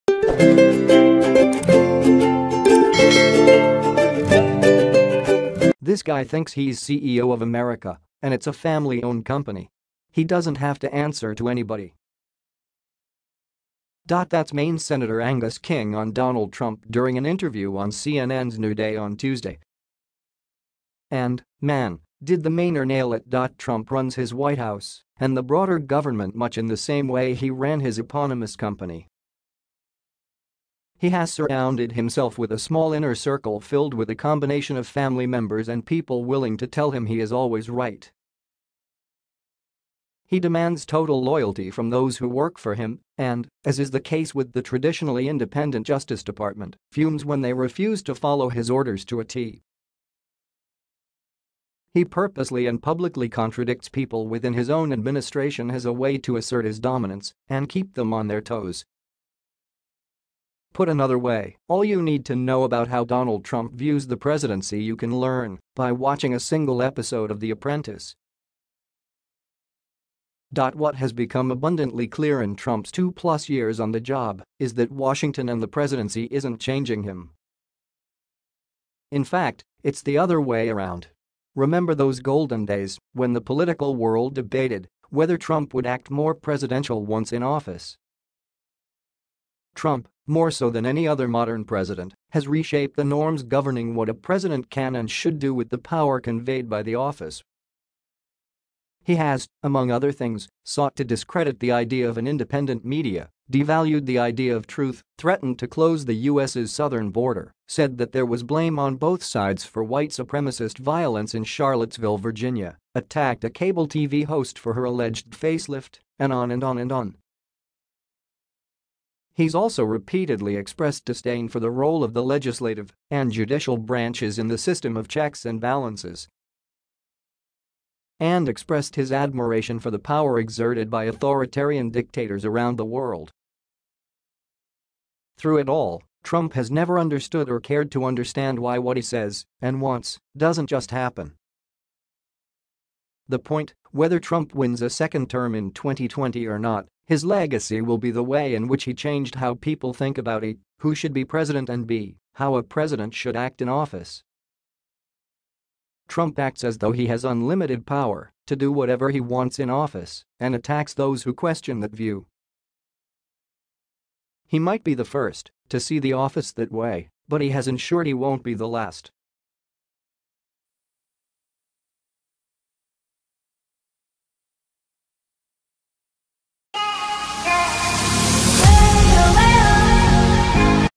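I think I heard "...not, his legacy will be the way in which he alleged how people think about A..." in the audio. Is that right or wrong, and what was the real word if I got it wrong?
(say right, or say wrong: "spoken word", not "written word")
wrong: "changed", not "alleged".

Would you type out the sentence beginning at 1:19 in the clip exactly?
In fact, it's the other way around.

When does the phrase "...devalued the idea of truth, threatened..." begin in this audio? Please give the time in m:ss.
1:43.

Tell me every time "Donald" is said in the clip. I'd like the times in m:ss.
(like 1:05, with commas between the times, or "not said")
0:16, 1:03.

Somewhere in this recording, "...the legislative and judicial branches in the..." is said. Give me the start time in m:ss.
2:02.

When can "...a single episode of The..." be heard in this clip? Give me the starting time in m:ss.
1:06.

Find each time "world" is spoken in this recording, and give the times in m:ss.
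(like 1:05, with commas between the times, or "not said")
1:23, 2:12.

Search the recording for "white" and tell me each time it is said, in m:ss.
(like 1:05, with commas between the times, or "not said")
0:24, 1:49.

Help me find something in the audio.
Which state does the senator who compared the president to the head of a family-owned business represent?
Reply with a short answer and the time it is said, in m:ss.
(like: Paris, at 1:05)
Maine, at 0:14.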